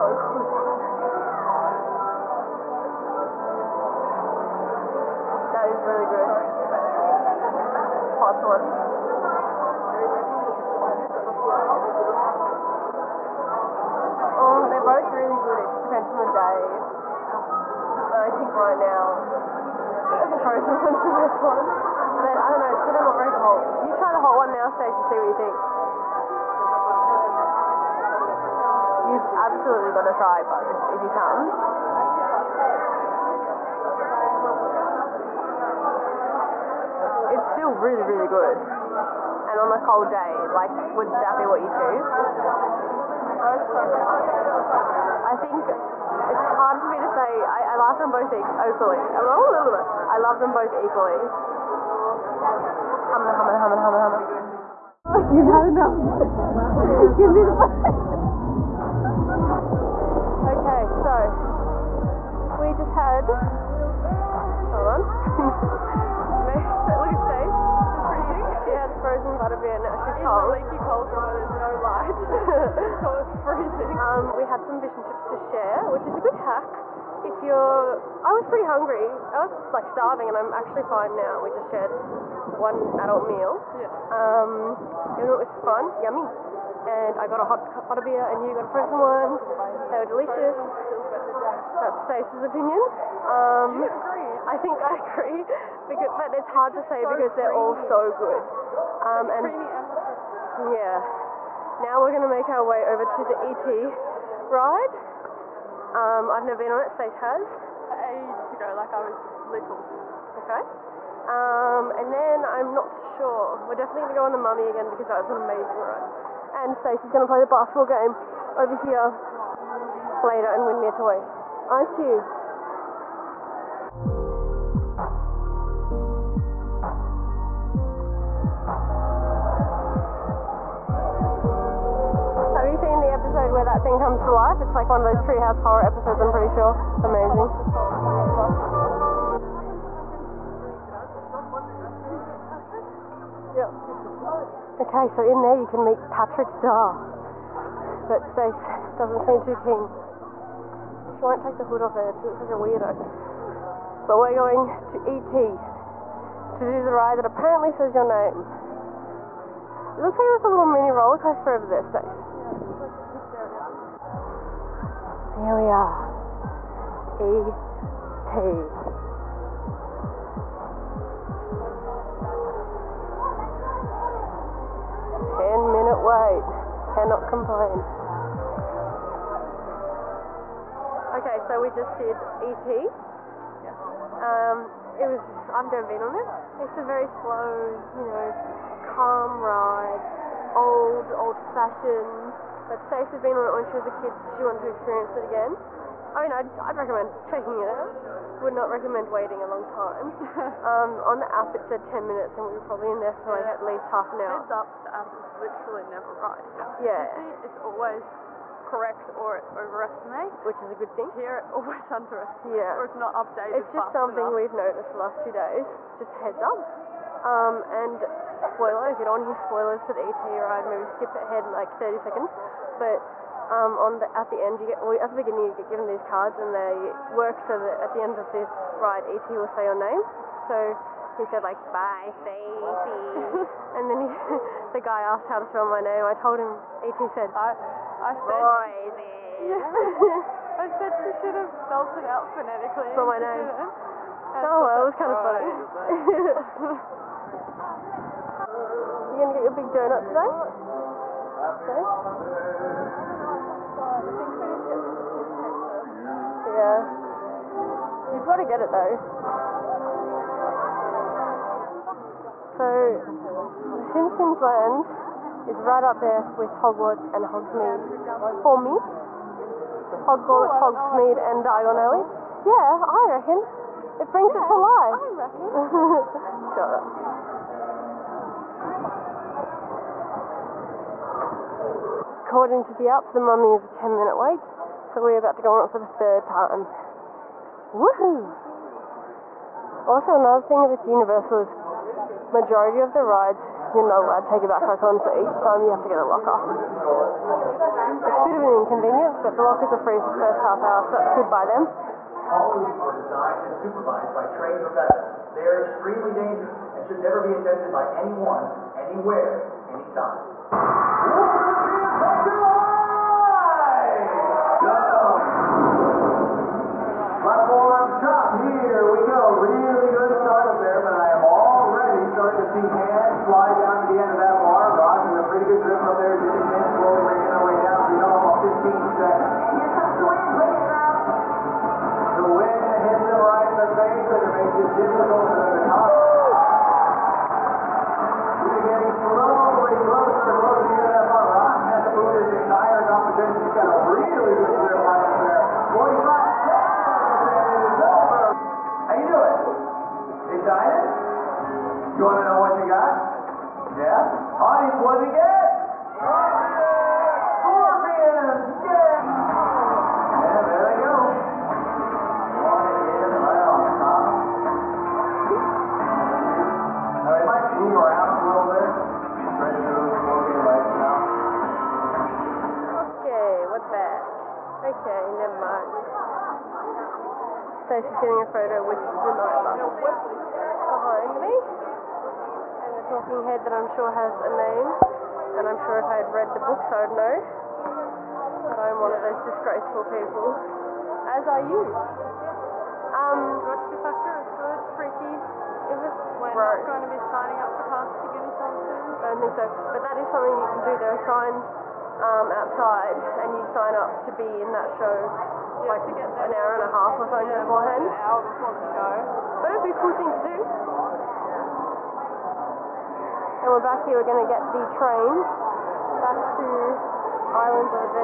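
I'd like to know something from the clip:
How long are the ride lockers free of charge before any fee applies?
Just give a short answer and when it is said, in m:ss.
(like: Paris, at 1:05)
Half an hour, at 5:00.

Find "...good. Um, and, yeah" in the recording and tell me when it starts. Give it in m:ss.
1:38.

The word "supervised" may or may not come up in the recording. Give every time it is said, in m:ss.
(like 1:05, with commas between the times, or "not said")
5:03.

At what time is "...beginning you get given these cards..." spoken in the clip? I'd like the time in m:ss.
3:45.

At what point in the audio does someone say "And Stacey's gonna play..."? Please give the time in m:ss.
1:56.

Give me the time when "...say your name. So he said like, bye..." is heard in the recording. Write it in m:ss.
3:49.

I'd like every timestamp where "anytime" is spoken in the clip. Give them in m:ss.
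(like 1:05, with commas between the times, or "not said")
5:09, 6:38.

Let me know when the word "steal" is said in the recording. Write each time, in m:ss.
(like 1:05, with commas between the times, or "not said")
not said.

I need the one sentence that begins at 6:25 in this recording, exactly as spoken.
And I'm sure if I had read the books I would know.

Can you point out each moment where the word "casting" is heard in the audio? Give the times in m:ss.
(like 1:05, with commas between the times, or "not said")
6:37.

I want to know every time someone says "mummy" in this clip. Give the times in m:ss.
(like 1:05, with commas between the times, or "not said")
1:54, 4:43.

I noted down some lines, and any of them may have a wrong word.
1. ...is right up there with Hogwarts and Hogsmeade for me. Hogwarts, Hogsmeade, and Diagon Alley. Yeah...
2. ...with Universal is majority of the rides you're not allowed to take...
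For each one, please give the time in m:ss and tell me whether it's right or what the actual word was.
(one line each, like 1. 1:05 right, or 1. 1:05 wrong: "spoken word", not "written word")
1. 4:25 right
2. 4:50 right.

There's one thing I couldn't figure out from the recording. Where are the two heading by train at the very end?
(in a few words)
Islands.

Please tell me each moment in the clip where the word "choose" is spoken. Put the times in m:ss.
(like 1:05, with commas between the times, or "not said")
0:41.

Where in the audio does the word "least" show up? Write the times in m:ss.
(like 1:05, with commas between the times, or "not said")
3:23.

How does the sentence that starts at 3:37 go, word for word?
Um, and spoiler, if you don't want to hear spoilers for the ET ride, maybe skip ahead like 30 seconds.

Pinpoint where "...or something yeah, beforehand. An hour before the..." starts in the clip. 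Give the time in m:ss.
6:47.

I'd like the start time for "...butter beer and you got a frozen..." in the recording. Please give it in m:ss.
1:27.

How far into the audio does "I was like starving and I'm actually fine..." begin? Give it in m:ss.
1:19.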